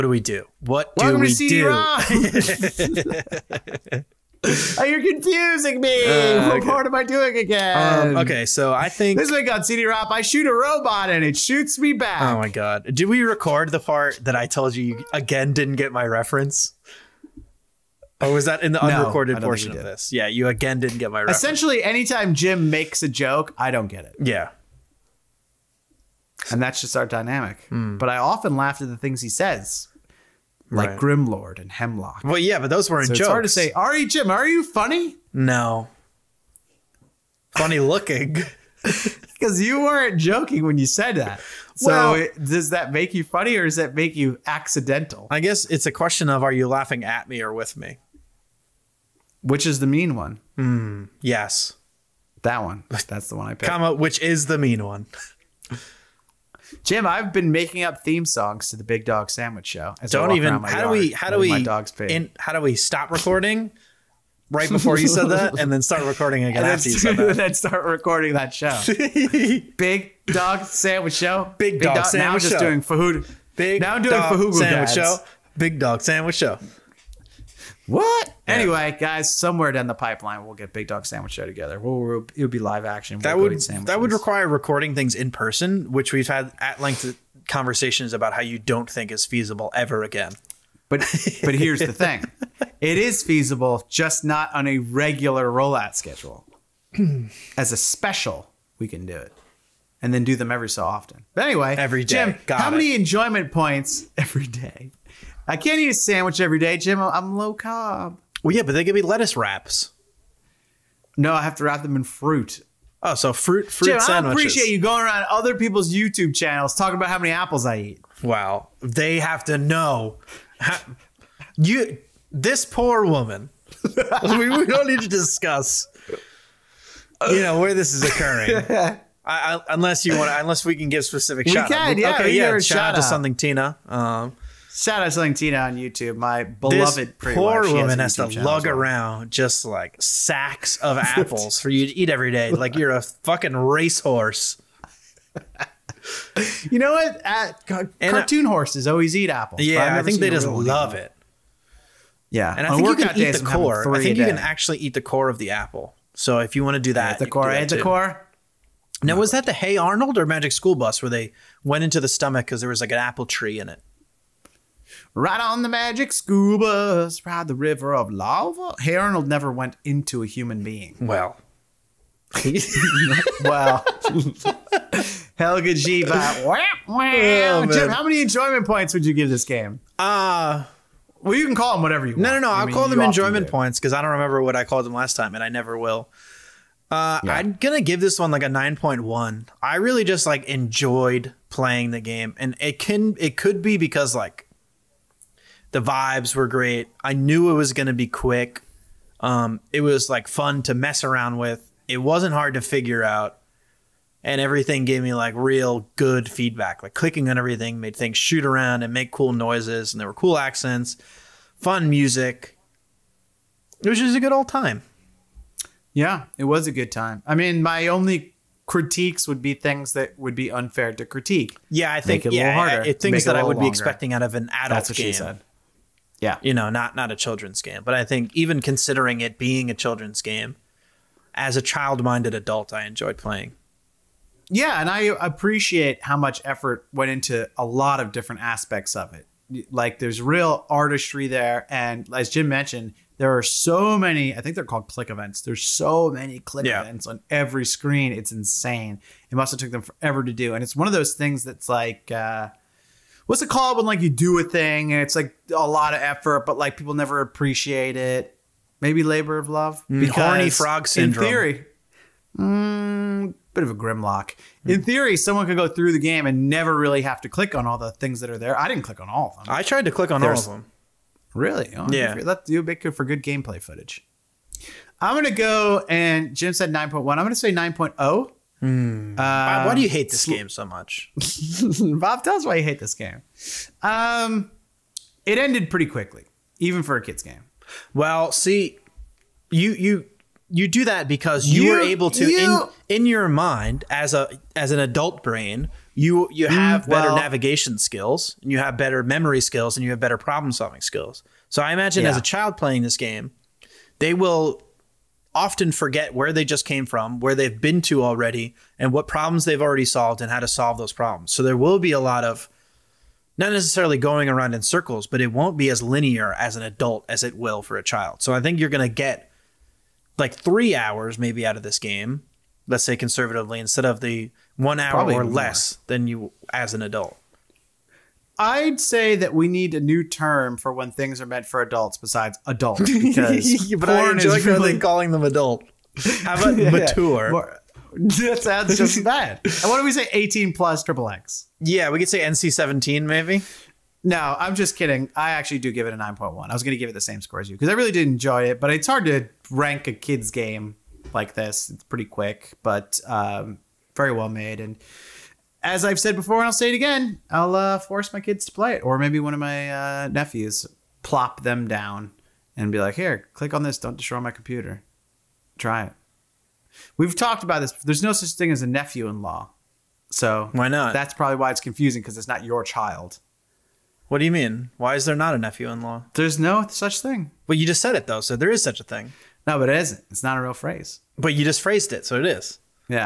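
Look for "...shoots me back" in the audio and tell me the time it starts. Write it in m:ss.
0:11.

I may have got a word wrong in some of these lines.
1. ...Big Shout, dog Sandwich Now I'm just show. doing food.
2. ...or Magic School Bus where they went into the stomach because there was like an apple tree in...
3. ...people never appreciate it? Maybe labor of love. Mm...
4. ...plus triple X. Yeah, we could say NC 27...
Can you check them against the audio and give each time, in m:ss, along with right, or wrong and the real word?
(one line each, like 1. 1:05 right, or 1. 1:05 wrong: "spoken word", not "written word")
1. 1:11 wrong: "Dog", not "Shout"
2. 2:40 right
3. 4:16 right
4. 5:40 wrong: "17", not "27".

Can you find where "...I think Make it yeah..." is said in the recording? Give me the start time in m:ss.
3:41.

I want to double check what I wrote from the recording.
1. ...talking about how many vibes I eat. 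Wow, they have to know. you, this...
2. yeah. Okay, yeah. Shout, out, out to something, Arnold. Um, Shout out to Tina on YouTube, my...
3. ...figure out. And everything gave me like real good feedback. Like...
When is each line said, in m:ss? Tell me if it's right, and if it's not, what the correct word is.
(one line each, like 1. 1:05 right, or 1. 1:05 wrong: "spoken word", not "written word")
1. 1:56 wrong: "apples", not "vibes"
2. 2:11 wrong: "Tina", not "Arnold"
3. 3:22 right.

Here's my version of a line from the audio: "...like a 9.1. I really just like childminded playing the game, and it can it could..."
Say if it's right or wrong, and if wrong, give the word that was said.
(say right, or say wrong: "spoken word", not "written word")
wrong: "enjoyed", not "childminded".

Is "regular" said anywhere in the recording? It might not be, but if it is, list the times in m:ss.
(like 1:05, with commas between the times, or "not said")
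1:34.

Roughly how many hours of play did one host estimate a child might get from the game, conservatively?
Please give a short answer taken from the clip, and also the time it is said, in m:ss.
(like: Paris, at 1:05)
3 hours, at 5:20.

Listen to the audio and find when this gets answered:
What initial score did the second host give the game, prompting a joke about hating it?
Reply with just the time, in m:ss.
4:37.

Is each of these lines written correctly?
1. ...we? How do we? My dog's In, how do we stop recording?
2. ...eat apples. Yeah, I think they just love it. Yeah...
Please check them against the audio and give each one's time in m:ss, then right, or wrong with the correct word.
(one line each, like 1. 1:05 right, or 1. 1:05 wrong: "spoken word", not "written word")
1. 1:00 right
2. 2:29 right.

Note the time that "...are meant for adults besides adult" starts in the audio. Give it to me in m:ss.
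5:31.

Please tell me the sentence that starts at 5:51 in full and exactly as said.
It's pretty quick, but um, very well made.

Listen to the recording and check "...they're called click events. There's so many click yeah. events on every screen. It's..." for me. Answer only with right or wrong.
right.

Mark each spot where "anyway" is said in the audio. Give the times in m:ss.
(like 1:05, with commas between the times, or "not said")
1:18, 1:41.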